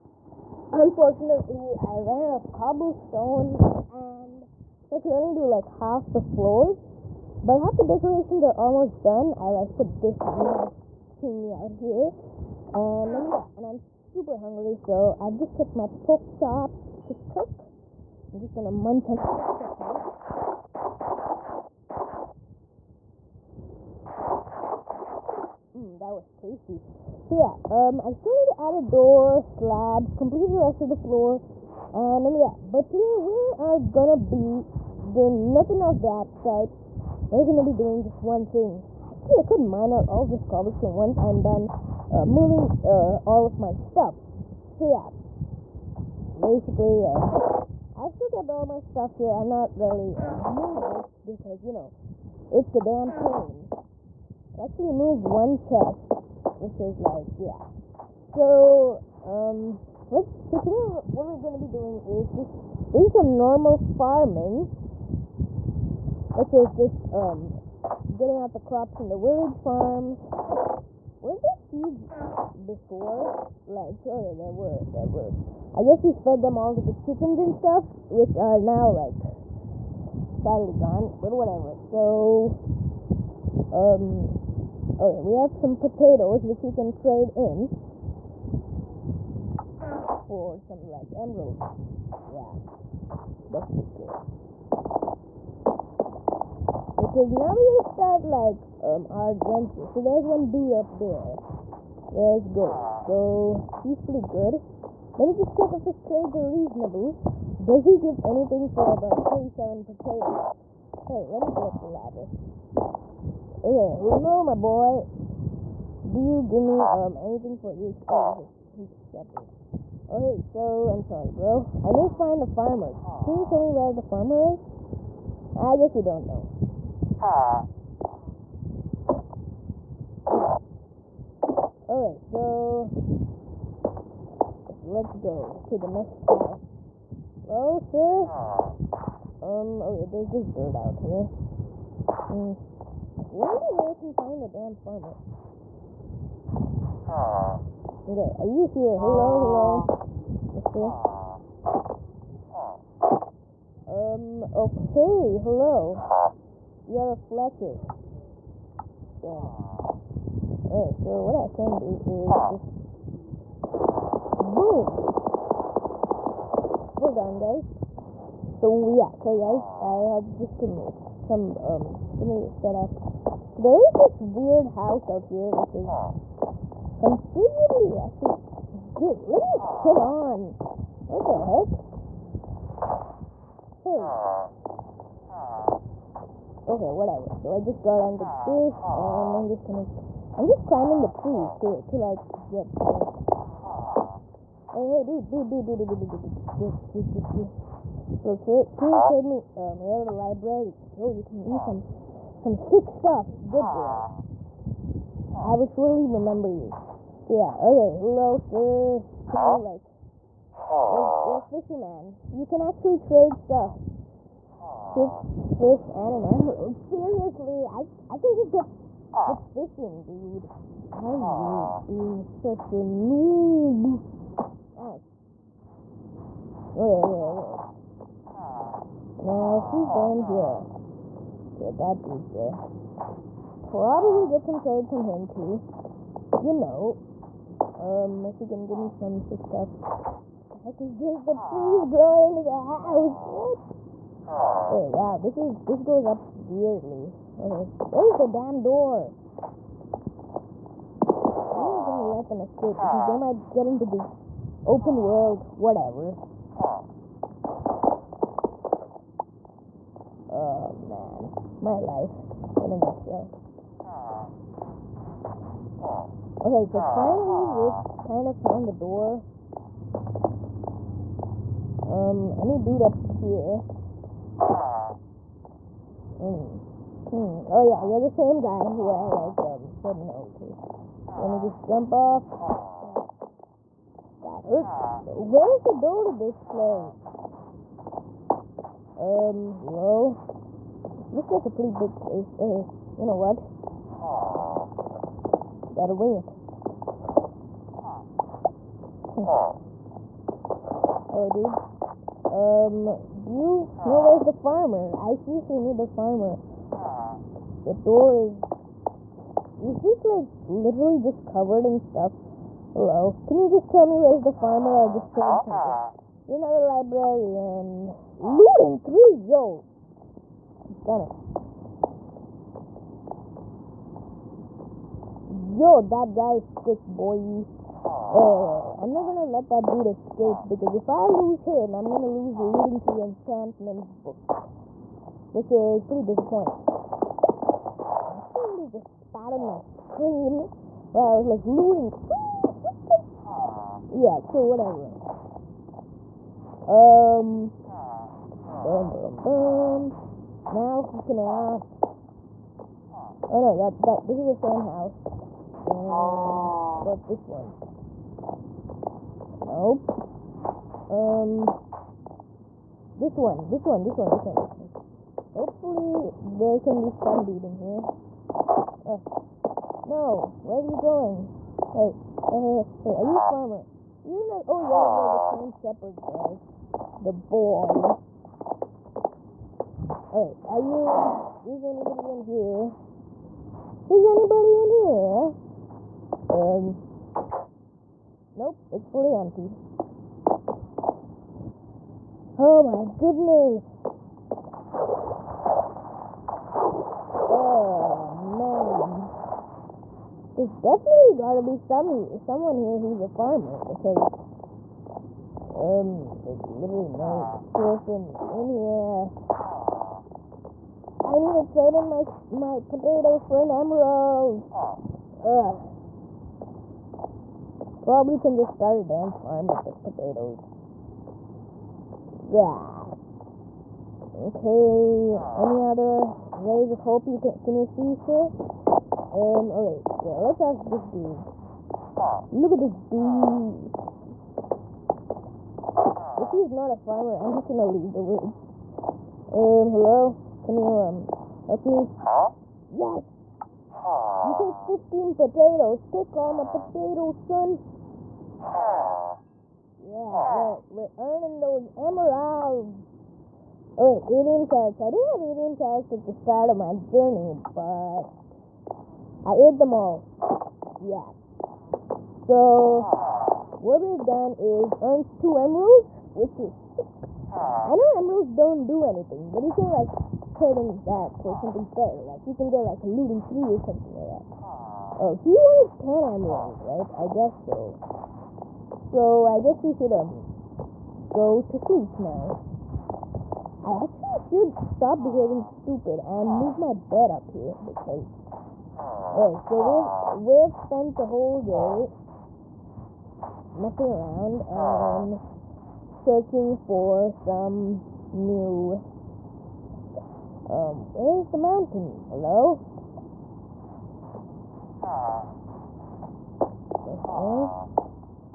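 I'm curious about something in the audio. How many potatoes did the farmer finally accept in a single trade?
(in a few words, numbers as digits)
15.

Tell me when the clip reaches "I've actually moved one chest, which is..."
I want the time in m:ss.
0:54.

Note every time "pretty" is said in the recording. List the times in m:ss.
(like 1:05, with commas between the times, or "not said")
1:44, 4:51, 5:35.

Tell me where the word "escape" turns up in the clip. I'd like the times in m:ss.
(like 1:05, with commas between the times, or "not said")
4:12, 5:29.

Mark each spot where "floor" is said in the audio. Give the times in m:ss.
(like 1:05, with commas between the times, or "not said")
0:06, 0:30.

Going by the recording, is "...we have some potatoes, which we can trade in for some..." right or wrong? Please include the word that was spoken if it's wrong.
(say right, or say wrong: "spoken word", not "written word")
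right.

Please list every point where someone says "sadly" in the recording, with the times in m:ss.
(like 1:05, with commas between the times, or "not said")
1:20.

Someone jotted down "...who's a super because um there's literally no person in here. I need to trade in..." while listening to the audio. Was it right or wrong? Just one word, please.
wrong.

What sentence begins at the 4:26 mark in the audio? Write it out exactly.
Okay, so finally we've kind of found the door.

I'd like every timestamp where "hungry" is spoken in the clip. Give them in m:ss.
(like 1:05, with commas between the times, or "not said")
0:14.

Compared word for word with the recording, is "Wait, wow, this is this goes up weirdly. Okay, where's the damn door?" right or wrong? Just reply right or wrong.
right.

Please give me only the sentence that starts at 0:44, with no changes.
So yeah, basically, uh, I've still kept all my stuff here.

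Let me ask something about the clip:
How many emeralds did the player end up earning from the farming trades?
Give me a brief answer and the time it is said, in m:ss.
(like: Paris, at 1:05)
2, at 7:45.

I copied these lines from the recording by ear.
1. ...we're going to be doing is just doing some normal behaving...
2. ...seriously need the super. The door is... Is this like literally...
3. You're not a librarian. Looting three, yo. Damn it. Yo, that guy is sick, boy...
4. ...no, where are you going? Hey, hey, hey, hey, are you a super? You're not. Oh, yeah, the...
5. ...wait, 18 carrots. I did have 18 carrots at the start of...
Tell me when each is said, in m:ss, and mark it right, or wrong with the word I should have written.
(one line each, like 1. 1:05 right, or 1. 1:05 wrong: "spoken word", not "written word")
1. 1:01 wrong: "farming", not "behaving"
2. 5:05 wrong: "farmer", not "super"
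3. 5:16 right
4. 6:09 wrong: "farmer", not "super"
5. 7:33 right.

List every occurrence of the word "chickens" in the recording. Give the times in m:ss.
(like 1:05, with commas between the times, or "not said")
1:16.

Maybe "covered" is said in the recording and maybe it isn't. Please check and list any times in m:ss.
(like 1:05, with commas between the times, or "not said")
5:11.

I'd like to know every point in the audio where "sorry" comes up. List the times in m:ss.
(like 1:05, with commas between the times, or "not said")
2:01, 2:49.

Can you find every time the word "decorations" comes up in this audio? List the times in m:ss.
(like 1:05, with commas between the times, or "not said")
0:07.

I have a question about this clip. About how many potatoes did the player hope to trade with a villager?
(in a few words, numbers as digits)
47.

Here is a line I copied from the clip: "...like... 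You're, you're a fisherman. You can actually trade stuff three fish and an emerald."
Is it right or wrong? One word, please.
wrong.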